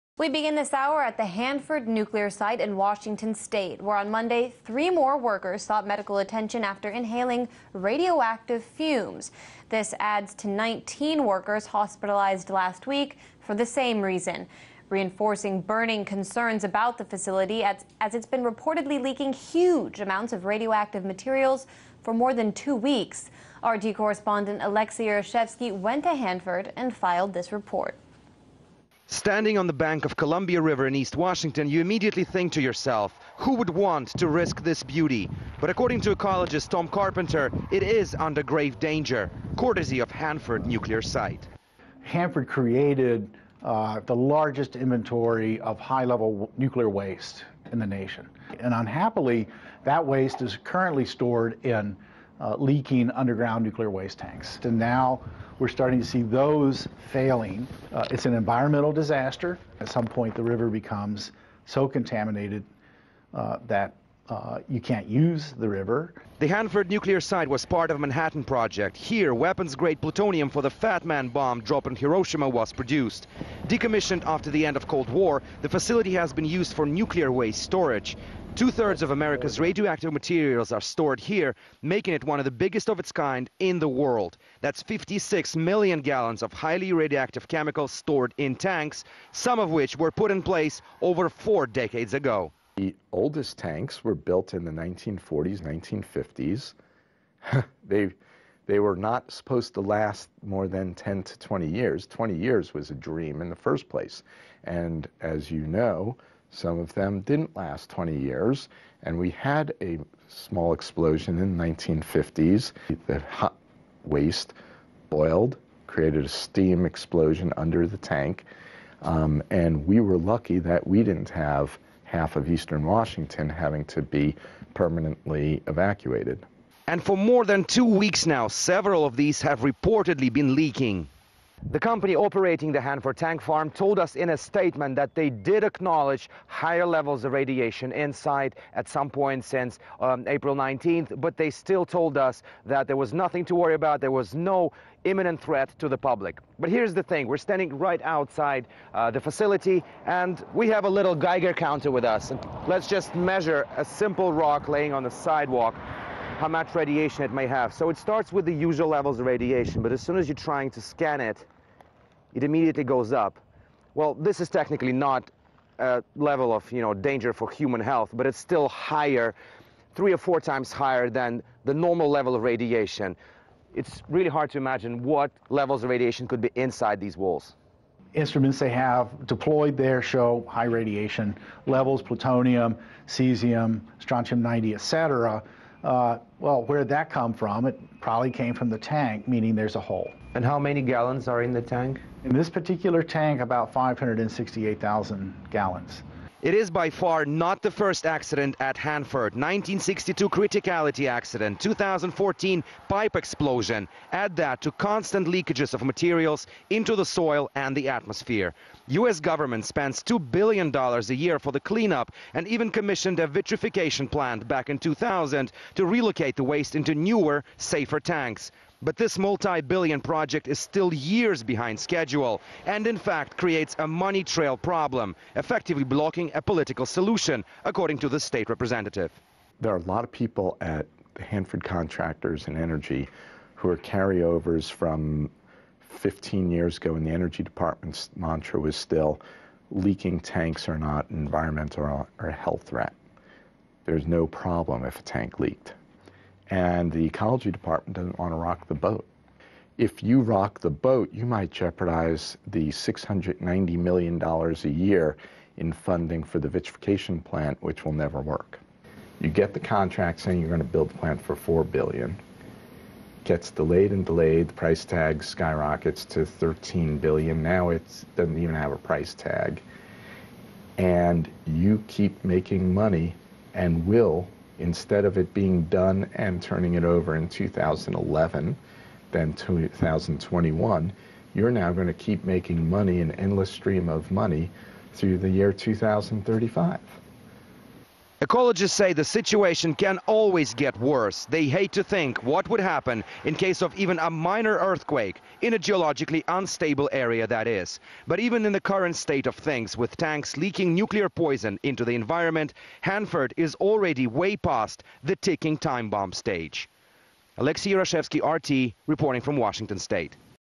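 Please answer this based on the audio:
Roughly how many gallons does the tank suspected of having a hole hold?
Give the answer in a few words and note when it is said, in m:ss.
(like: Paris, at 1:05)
568,000 gallons, at 3:13.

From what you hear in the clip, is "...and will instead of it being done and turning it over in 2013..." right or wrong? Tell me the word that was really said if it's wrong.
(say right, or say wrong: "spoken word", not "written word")
wrong: "2011", not "2013".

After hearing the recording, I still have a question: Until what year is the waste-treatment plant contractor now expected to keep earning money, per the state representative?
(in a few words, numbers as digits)
2035.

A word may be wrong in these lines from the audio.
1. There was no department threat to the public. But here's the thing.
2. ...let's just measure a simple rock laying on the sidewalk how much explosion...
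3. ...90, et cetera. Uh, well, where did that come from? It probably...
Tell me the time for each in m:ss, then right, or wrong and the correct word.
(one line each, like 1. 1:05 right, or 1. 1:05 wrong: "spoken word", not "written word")
1. 2:24 wrong: "imminent", not "department"
2. 2:32 wrong: "radiation", not "explosion"
3. 3:04 right.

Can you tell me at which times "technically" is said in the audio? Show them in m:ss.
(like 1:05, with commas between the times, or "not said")
2:44.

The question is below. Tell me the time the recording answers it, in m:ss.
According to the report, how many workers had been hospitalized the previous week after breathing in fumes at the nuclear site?
0:10.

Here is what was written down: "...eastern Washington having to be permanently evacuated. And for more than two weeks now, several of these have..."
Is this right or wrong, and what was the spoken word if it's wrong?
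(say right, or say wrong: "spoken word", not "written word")
right.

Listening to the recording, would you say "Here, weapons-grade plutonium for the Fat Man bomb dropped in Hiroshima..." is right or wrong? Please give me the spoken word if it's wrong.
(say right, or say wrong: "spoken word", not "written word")
right.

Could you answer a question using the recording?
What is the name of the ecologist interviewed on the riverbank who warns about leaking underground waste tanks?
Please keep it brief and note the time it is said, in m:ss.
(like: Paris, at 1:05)
Tom Carpenter, at 0:36.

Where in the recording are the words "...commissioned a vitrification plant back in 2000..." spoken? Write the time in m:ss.
3:32.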